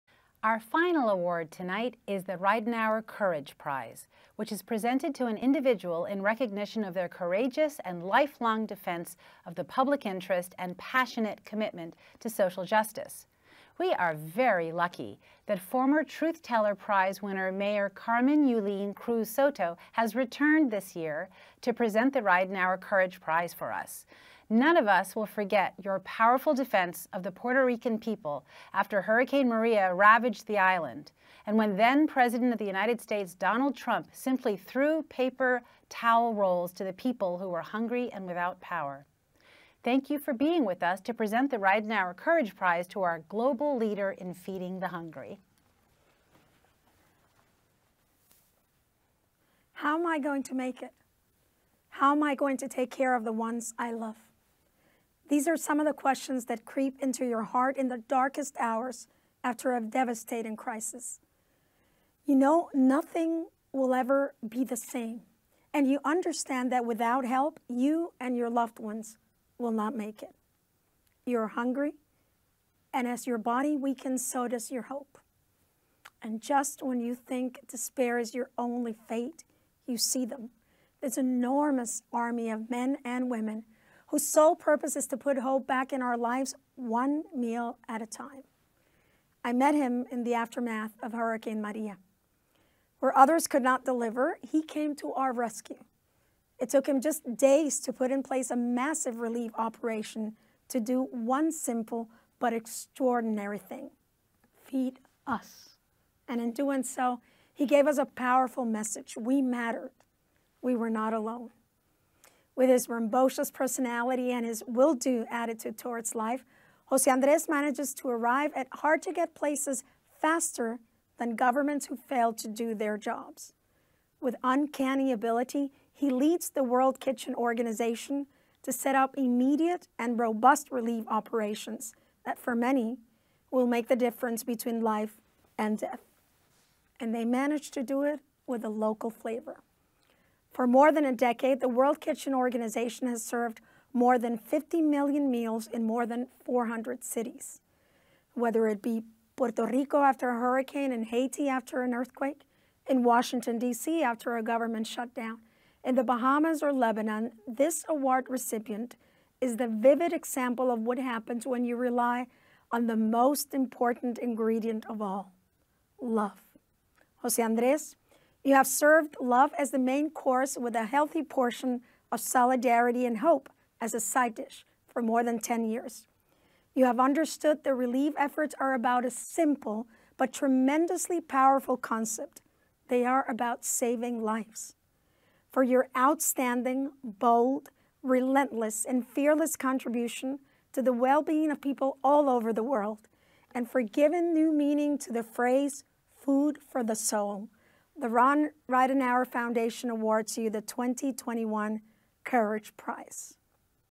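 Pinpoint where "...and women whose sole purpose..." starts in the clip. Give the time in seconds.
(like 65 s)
83 s.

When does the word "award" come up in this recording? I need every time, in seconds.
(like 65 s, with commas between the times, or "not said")
1 s, 157 s, 199 s.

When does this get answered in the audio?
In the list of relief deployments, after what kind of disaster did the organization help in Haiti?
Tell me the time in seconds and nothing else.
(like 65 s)
151 s.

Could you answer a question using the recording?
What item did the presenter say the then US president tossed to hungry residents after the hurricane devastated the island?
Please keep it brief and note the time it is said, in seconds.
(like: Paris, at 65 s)
paper towel rolls, at 35 s.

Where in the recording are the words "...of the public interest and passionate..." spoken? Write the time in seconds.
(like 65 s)
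9 s.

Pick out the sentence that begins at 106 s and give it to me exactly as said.
And in doing so, he gave us a powerful message.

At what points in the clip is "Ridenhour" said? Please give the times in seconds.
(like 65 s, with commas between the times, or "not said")
2 s, 22 s, 41 s, 198 s.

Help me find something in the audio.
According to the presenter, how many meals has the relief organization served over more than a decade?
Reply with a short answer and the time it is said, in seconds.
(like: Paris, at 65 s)
more than 50 million, at 143 s.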